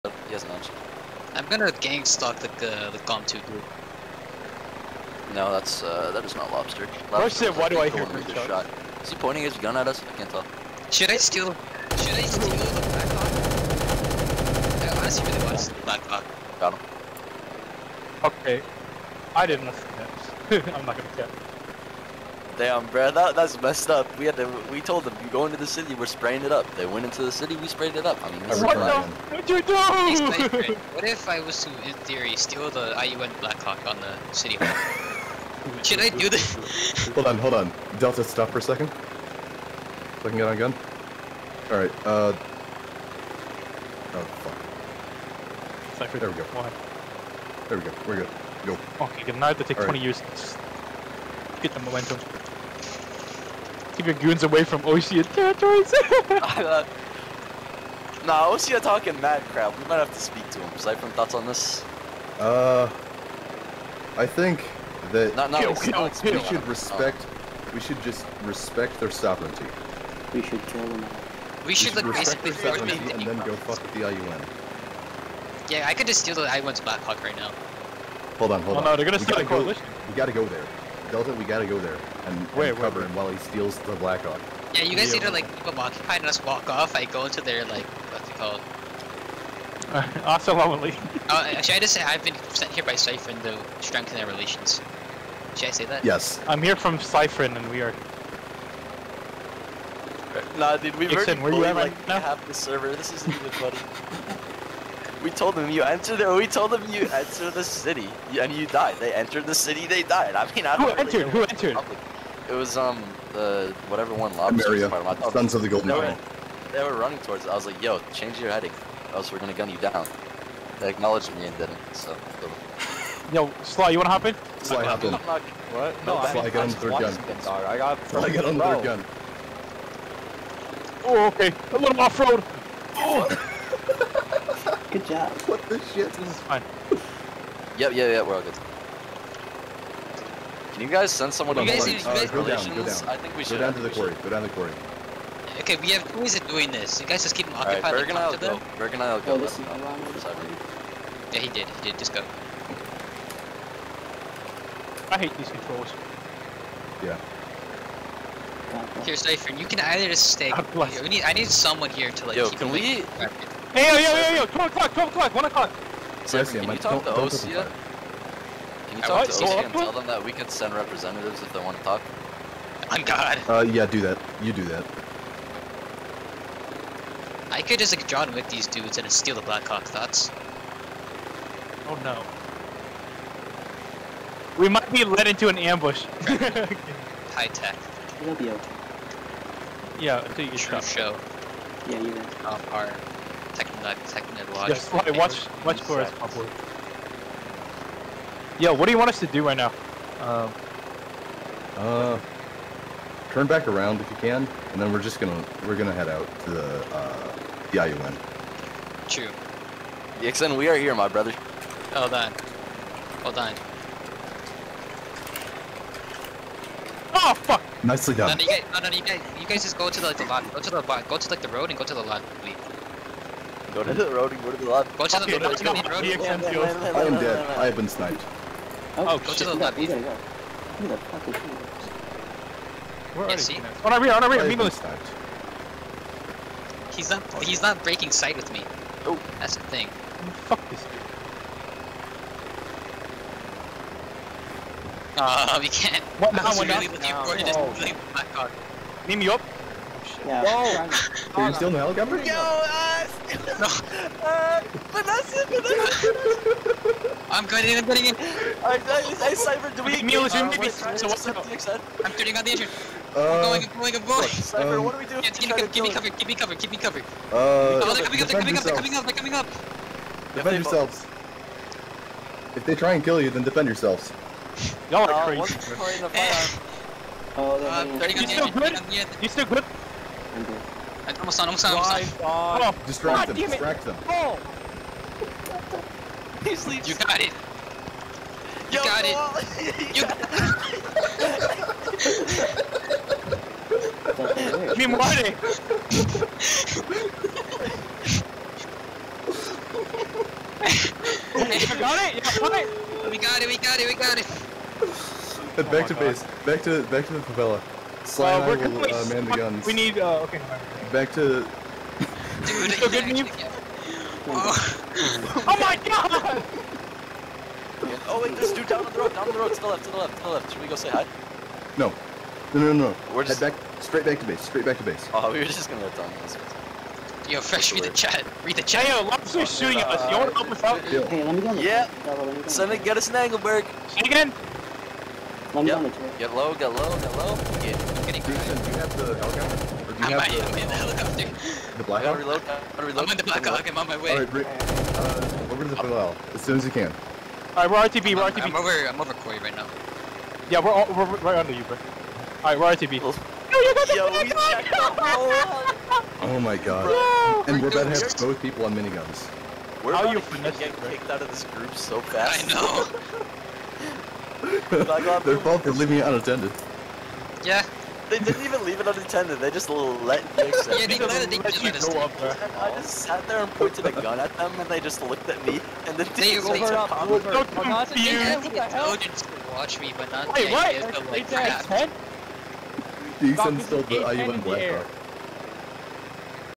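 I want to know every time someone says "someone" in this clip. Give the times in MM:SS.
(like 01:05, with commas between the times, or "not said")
02:21, 02:41.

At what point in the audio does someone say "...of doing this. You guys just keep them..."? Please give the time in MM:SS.
02:26.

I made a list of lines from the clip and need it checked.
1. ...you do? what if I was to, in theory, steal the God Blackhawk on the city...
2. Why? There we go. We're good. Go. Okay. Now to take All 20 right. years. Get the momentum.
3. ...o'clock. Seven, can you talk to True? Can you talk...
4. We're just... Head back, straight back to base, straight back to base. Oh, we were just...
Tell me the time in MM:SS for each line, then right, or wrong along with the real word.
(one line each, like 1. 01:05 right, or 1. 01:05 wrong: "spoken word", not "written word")
1. 00:29 wrong: "IUN", not "God"
2. 00:46 right
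3. 02:45 wrong: "OSEA", not "True"
4. 05:23 right.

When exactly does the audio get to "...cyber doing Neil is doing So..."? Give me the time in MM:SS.
04:19.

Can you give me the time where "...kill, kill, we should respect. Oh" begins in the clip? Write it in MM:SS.
01:05.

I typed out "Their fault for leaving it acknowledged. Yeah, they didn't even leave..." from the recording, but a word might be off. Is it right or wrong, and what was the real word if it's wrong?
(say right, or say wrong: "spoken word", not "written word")
wrong: "unattended", not "acknowledged".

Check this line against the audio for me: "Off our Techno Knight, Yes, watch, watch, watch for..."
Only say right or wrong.
right.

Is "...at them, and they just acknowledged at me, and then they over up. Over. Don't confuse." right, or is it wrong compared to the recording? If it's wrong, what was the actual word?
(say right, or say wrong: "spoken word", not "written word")
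wrong: "looked", not "acknowledged".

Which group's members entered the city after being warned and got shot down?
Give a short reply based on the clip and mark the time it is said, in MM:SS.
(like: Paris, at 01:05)
Sons of the Golden, at 01:55.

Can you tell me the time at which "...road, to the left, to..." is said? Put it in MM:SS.
05:19.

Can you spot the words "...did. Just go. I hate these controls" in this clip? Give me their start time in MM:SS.
02:31.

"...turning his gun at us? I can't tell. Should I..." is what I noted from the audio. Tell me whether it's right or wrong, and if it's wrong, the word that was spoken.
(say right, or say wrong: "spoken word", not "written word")
wrong: "pointing", not "turning".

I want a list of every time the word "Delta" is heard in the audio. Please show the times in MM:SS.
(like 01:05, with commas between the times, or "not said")
00:37, 01:21.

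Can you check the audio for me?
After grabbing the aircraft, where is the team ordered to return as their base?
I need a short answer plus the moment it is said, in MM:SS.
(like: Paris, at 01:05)
the favela, at 05:07.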